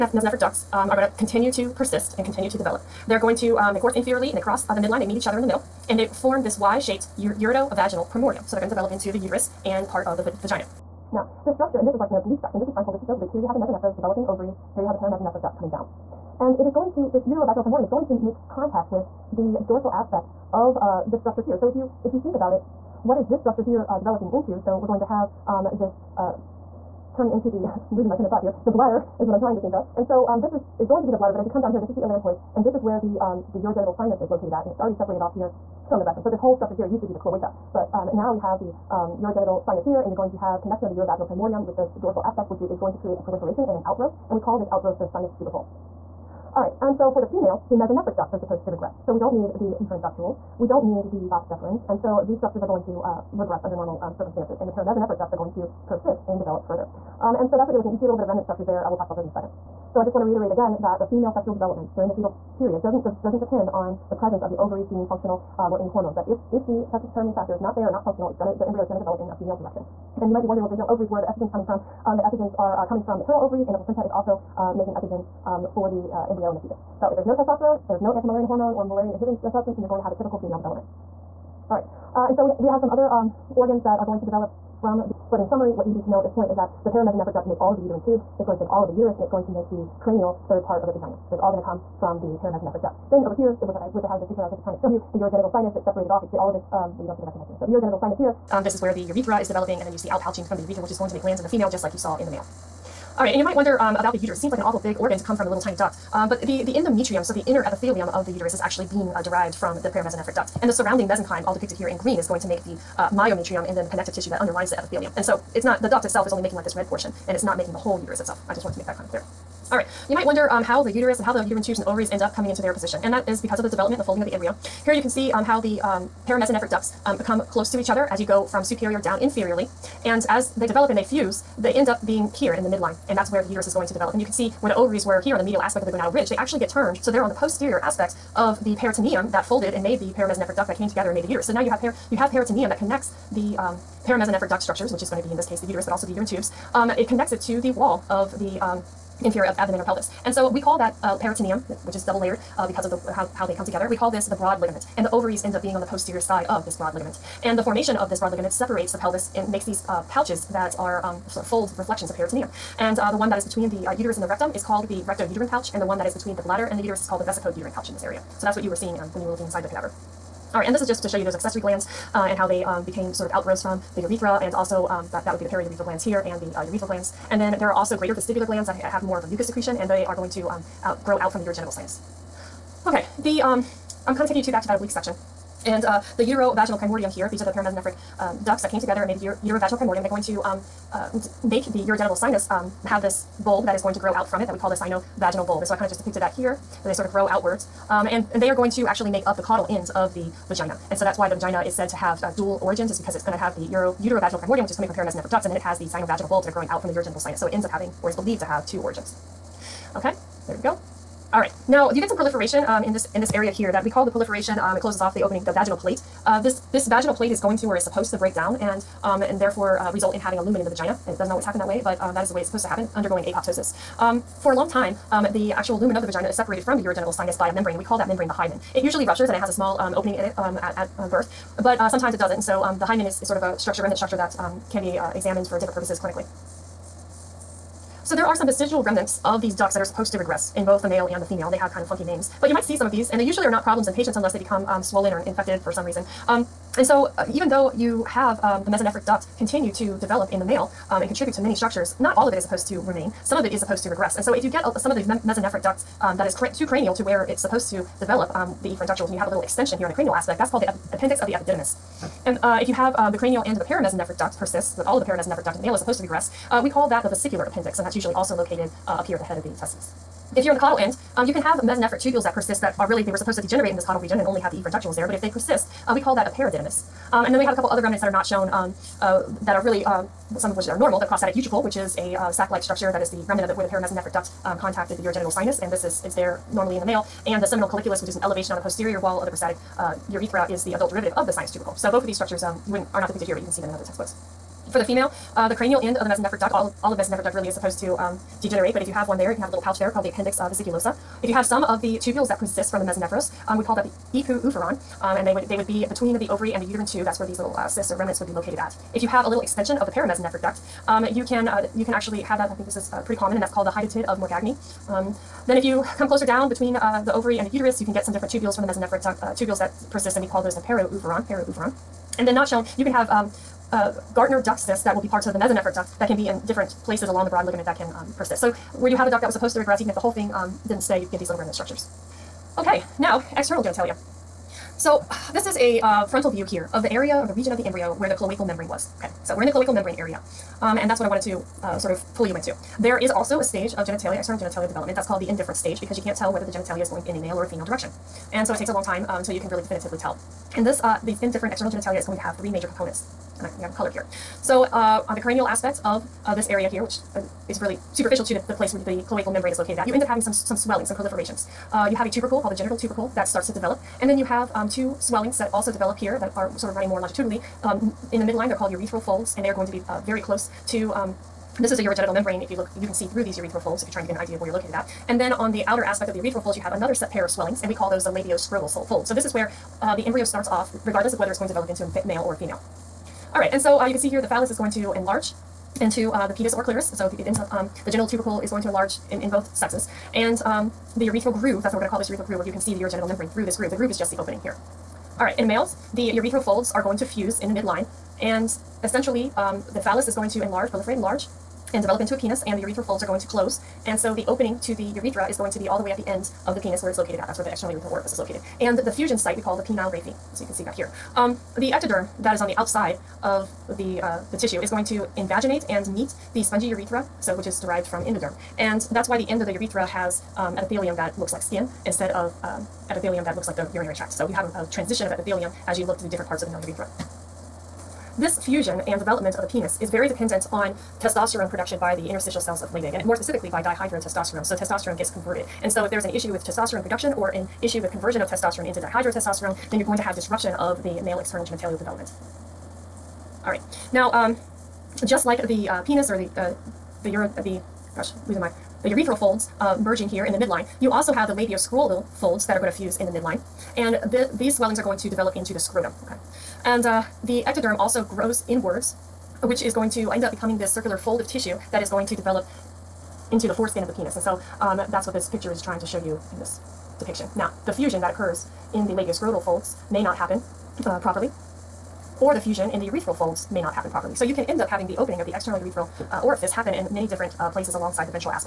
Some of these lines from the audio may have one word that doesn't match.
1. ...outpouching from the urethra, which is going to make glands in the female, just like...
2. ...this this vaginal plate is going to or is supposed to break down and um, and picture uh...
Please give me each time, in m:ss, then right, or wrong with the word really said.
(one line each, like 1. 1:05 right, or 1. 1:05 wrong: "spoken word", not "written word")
1. 1:40 right
2. 3:36 wrong: "therefore", not "picture".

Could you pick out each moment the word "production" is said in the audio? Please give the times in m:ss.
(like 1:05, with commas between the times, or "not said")
7:11, 7:16.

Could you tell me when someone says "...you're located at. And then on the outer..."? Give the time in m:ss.
6:14.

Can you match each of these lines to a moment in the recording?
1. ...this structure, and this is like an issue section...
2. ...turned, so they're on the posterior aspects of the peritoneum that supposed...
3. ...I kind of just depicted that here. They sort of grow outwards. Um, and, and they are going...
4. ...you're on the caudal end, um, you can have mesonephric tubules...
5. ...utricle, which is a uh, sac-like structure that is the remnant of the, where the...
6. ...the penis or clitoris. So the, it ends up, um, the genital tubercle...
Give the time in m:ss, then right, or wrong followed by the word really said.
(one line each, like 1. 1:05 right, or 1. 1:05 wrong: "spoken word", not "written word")
1. 0:11 wrong: "oblique", not "issue"
2. 2:16 wrong: "folded", not "supposed"
3. 3:15 right
4. 4:30 right
5. 4:41 right
6. 6:26 right.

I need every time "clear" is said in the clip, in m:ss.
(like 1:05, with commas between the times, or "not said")
1:59.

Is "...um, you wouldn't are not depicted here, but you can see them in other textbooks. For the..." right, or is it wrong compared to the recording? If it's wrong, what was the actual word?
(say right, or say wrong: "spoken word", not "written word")
right.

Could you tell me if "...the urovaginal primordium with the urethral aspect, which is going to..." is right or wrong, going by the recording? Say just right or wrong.
wrong.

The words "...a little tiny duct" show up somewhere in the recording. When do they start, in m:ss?
1:45.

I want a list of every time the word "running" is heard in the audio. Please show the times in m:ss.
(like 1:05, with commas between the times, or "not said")
6:06.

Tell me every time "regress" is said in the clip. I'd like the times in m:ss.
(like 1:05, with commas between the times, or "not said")
0:48, 0:53, 4:00, 4:13, 4:26, 5:29.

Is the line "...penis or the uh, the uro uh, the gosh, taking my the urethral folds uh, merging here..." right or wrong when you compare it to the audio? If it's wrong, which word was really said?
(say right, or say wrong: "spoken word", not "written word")
wrong: "losing", not "taking".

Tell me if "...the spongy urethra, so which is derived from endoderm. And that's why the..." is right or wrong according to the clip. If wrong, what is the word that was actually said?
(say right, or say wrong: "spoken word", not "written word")
right.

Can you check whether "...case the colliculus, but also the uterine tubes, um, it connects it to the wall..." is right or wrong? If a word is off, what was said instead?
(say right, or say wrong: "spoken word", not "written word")
wrong: "uterus", not "colliculus".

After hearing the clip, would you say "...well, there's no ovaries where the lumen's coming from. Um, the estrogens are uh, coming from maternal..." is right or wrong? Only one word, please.
wrong.